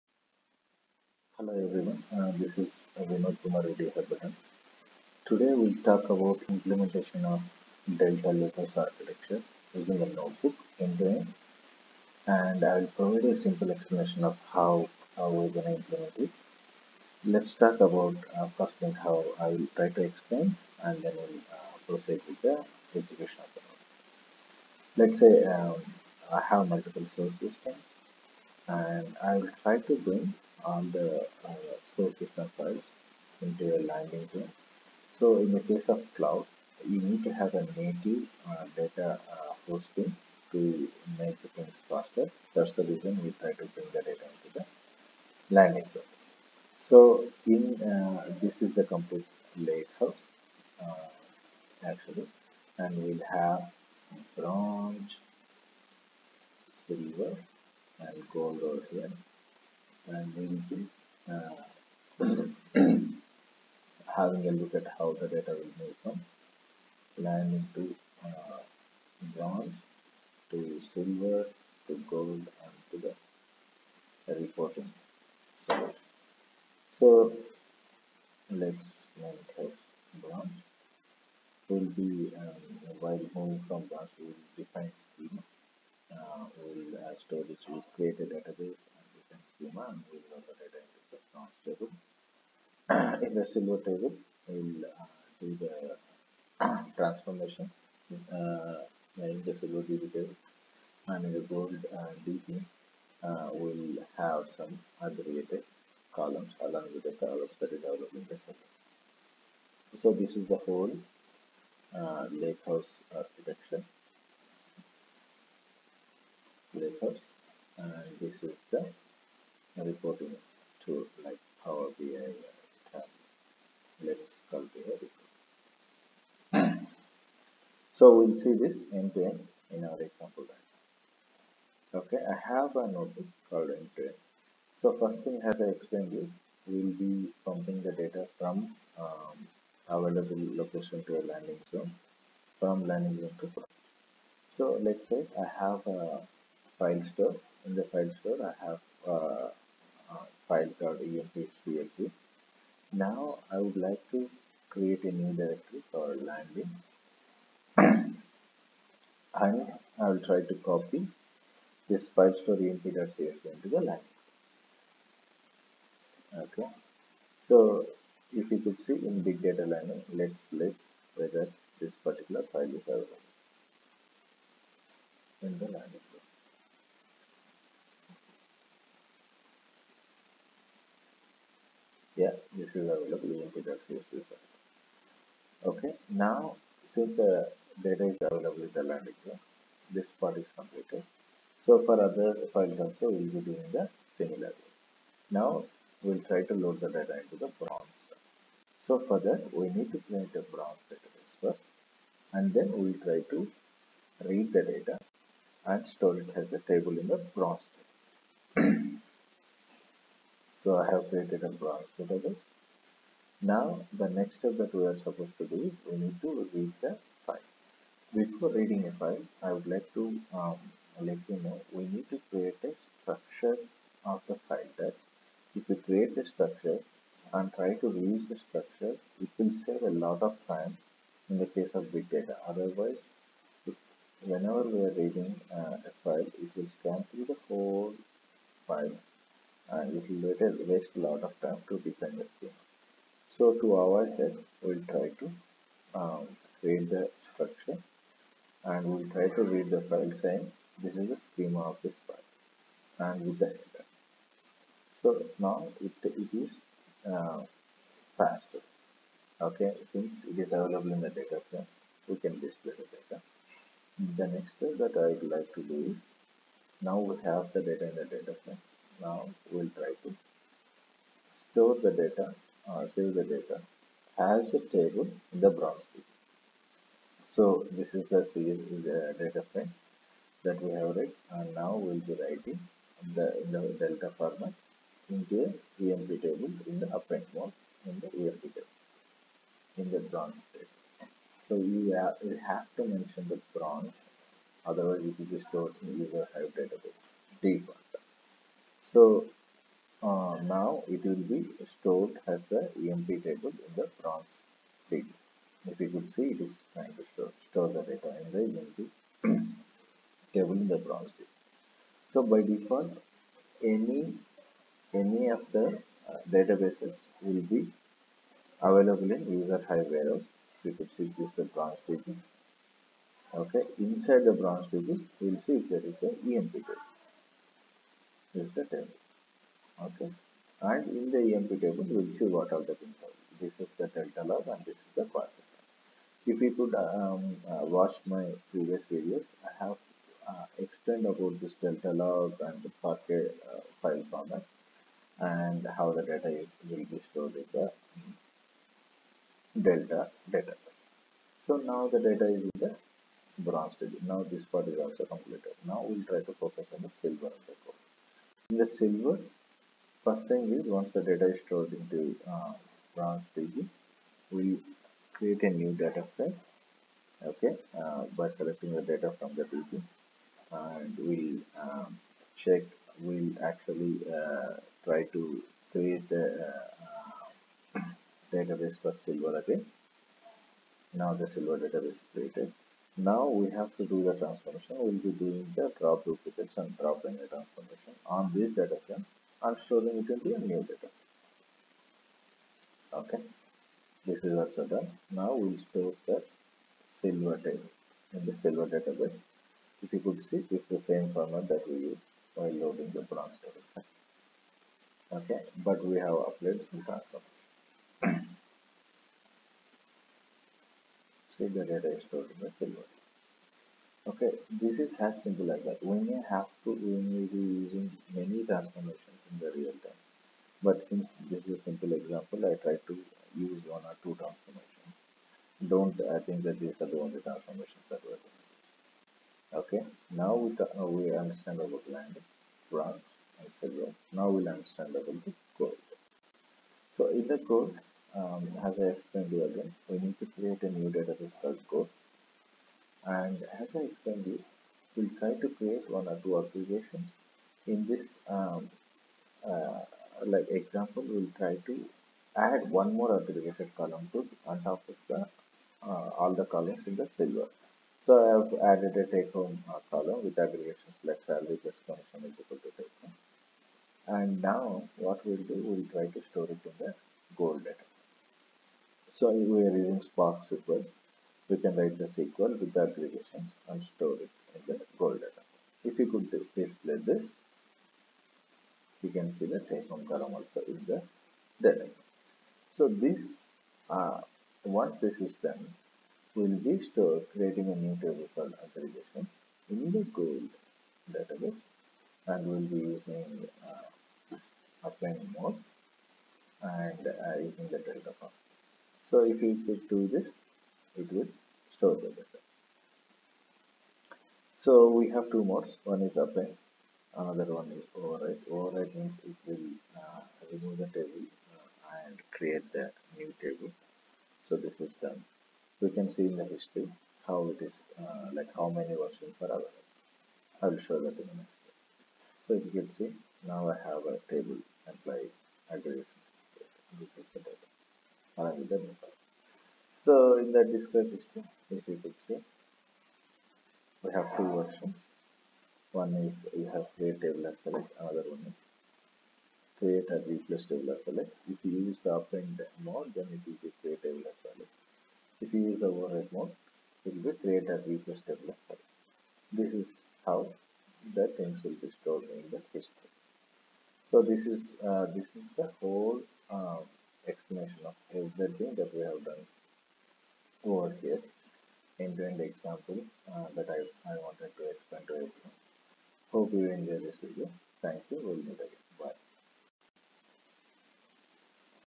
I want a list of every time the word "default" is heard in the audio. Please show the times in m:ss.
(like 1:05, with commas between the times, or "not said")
4:57, 5:12.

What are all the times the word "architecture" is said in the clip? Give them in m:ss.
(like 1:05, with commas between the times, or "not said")
0:08, 1:53.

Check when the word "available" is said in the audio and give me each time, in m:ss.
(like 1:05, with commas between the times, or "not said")
2:19, 2:52, 3:02, 3:08, 4:20, 5:18, 8:39.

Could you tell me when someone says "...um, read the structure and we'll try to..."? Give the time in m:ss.
4:05.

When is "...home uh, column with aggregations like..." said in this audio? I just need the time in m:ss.
7:39.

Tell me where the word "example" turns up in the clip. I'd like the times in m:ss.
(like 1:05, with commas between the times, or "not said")
2:10, 7:01, 7:30, 9:22.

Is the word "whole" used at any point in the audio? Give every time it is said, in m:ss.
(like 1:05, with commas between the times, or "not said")
1:50, 3:57, 9:15.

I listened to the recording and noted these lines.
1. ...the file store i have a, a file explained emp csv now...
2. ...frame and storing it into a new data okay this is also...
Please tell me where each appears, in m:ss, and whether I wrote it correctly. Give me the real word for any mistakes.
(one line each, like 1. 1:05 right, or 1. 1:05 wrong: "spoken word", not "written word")
1. 2:27 wrong: "called", not "explained"
2. 6:28 right.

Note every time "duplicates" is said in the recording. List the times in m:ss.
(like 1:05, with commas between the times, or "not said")
6:26.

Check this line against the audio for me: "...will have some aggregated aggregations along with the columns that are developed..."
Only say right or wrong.
wrong.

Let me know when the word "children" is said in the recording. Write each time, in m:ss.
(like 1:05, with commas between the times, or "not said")
not said.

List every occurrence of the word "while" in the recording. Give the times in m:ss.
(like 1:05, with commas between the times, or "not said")
1:22, 6:42.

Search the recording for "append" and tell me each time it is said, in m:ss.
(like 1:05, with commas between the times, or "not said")
4:46, 8:26, 9:02.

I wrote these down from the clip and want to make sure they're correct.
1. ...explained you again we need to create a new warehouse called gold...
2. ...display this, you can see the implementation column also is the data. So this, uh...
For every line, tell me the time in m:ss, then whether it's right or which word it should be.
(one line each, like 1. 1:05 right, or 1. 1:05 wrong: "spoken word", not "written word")
1. 7:18 wrong: "database", not "warehouse"
2. 7:56 wrong: "typhoon", not "implementation".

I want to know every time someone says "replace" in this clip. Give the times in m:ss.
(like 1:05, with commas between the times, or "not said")
9:00, 9:07.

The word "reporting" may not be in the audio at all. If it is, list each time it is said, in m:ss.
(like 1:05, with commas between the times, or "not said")
1:14, 1:59.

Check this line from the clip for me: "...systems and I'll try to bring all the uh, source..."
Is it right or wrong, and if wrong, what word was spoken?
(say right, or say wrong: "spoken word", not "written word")
right.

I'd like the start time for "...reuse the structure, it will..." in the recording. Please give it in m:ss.
3:47.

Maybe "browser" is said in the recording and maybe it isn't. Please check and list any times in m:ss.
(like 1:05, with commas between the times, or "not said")
4:35.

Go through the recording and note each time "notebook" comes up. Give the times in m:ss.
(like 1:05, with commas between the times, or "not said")
0:10, 0:23, 2:12.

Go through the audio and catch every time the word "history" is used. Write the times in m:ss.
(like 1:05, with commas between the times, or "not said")
8:36, 8:51, 9:12.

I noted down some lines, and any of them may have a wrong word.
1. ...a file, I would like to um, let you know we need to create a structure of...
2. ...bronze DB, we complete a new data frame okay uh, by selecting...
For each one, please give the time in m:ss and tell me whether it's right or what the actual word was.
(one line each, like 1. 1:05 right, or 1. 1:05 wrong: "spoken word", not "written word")
1. 3:38 right
2. 6:02 wrong: "create", not "complete".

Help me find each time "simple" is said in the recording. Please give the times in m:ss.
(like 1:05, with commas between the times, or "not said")
0:13, 6:55, 7:01.